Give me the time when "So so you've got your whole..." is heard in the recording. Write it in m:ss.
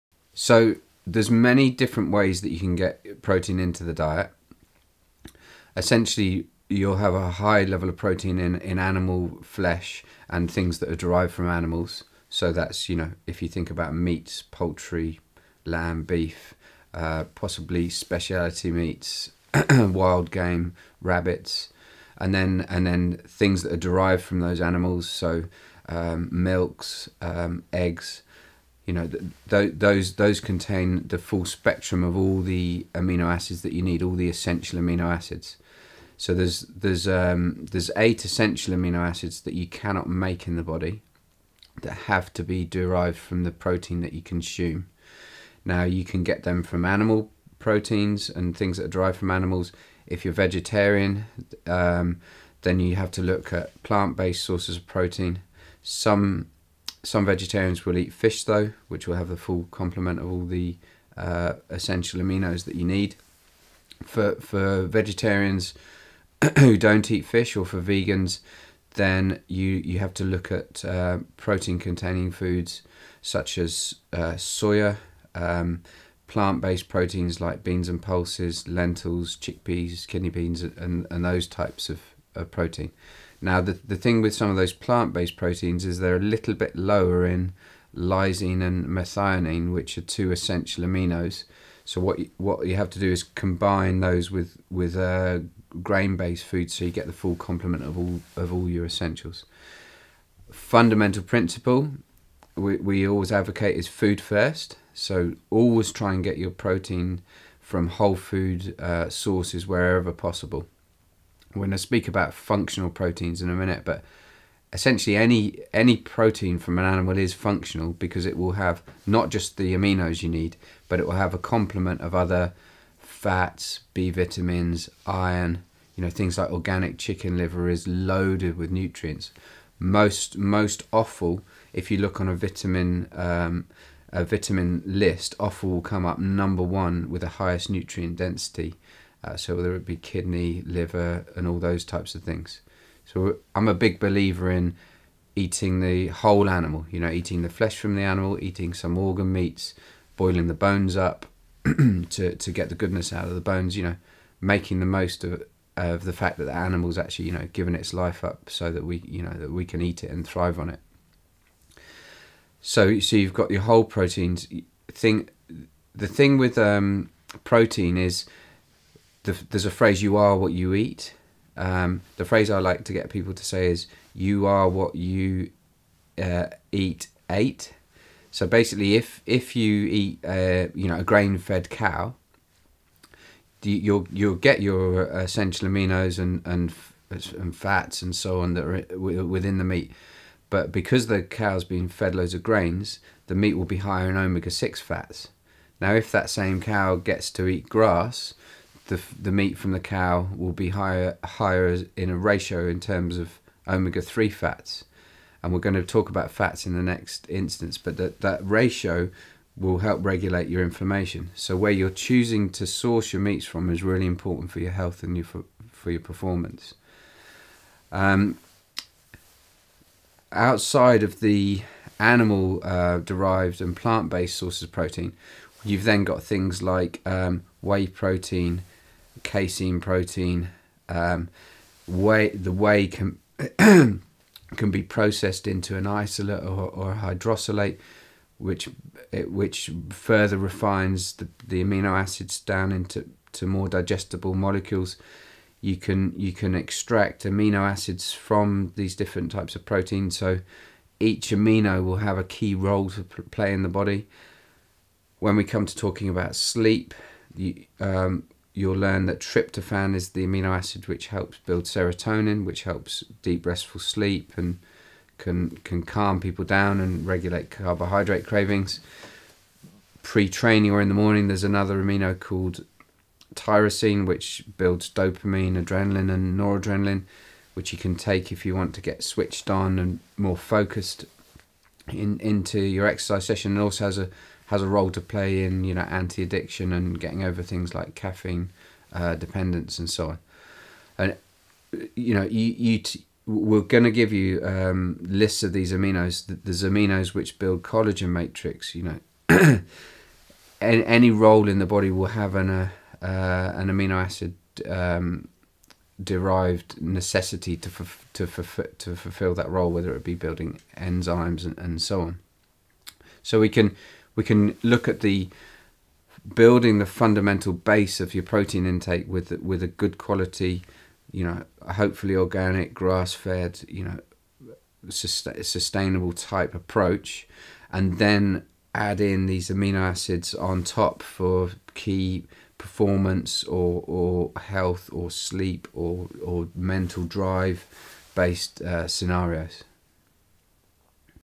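2:42.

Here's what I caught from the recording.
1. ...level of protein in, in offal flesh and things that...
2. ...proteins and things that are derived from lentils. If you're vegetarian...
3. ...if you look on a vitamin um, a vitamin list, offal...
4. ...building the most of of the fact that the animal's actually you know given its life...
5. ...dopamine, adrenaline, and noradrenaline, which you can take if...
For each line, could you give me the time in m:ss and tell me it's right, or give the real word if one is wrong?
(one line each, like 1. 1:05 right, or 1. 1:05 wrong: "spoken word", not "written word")
1. 0:07 wrong: "animal", not "offal"
2. 0:47 wrong: "animals", not "lentils"
3. 2:11 right
4. 2:34 wrong: "making", not "building"
5. 4:34 right.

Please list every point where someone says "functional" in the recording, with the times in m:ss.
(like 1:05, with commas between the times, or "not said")
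1:52, 1:57.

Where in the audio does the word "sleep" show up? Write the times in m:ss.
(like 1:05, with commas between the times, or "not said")
4:16, 4:23, 5:35.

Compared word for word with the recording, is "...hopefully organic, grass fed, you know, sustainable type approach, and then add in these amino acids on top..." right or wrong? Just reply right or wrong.
right.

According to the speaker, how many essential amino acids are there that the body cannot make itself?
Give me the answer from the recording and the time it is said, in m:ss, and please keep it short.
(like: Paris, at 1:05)
8, at 0:37.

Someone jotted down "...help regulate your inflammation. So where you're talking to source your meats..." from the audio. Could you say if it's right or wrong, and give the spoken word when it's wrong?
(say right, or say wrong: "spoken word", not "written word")
wrong: "choosing", not "talking".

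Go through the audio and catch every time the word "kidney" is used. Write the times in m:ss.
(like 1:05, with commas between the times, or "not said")
1:20, 2:19.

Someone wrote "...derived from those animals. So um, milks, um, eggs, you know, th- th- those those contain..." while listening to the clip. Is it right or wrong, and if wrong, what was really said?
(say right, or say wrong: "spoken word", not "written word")
right.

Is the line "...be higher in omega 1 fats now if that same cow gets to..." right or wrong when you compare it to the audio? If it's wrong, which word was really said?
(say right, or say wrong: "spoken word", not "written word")
wrong: "6", not "1".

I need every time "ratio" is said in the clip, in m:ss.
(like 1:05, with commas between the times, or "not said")
3:22, 3:28.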